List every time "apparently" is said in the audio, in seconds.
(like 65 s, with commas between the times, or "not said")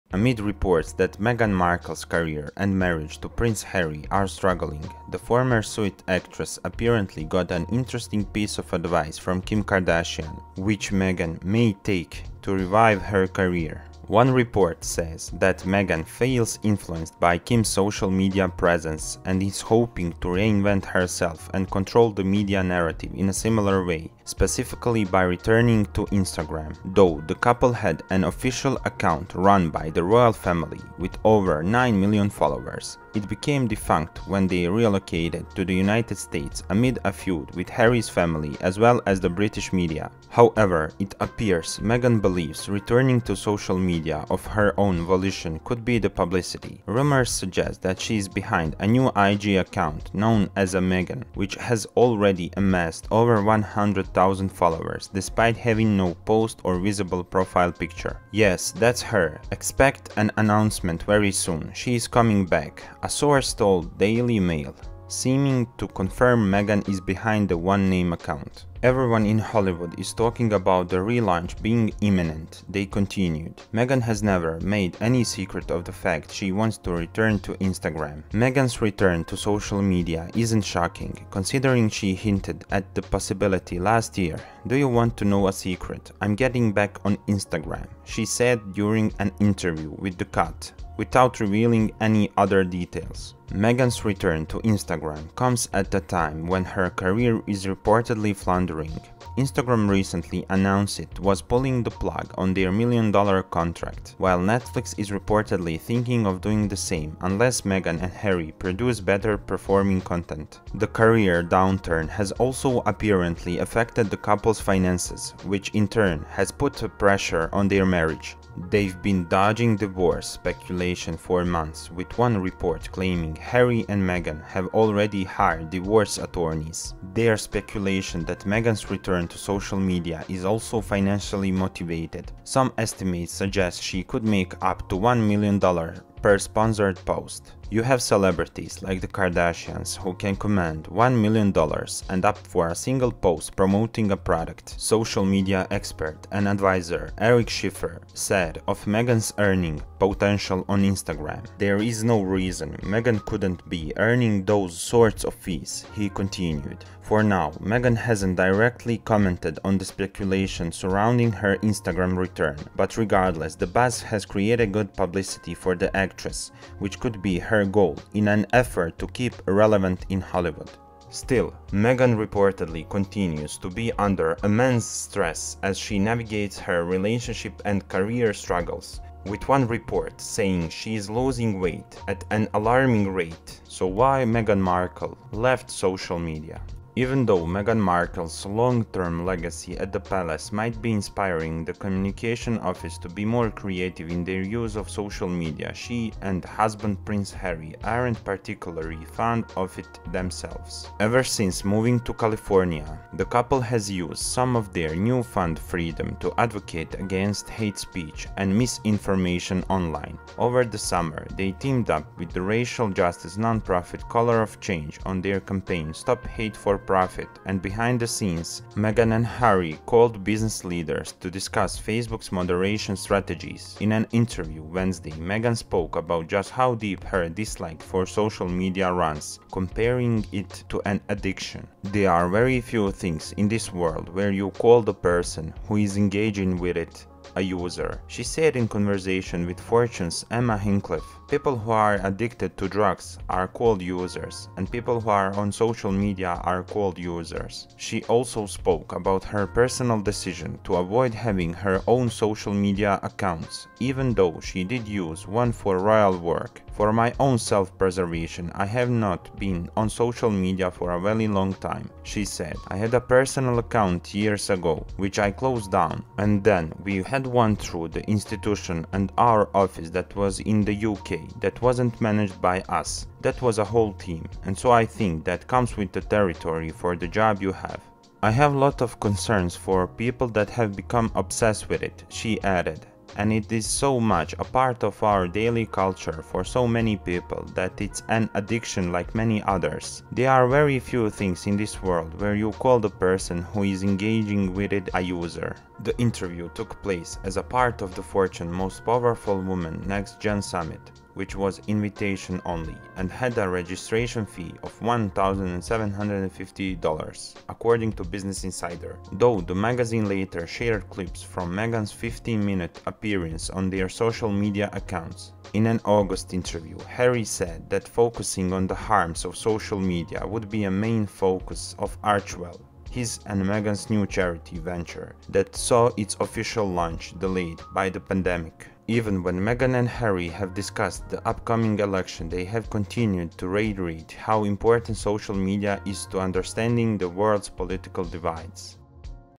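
6 s, 112 s.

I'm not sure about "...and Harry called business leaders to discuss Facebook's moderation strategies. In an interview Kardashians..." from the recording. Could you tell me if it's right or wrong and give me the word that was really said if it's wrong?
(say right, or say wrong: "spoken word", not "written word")
wrong: "Wednesday", not "Kardashians".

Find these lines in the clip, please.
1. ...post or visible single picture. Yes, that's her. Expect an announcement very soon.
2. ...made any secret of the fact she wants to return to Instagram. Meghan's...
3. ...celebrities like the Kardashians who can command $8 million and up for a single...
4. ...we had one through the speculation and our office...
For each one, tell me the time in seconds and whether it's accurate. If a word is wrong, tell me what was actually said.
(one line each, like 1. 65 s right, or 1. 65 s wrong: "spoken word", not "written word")
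1. 56 s wrong: "profile", not "single"
2. 74 s right
3. 138 s wrong: "1", not "8"
4. 266 s wrong: "institution", not "speculation".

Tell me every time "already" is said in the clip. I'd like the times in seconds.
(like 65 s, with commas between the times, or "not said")
51 s, 124 s.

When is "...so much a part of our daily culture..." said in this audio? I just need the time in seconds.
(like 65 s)
283 s.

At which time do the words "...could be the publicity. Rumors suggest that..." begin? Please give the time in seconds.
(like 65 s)
45 s.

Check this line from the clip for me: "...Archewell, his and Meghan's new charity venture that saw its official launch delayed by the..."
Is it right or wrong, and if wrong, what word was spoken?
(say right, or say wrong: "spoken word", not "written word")
right.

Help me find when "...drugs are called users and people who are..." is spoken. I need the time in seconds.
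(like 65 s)
242 s.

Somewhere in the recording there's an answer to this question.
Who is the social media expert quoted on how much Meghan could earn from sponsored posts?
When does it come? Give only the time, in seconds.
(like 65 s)
147 s.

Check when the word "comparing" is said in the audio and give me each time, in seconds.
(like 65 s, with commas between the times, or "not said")
229 s.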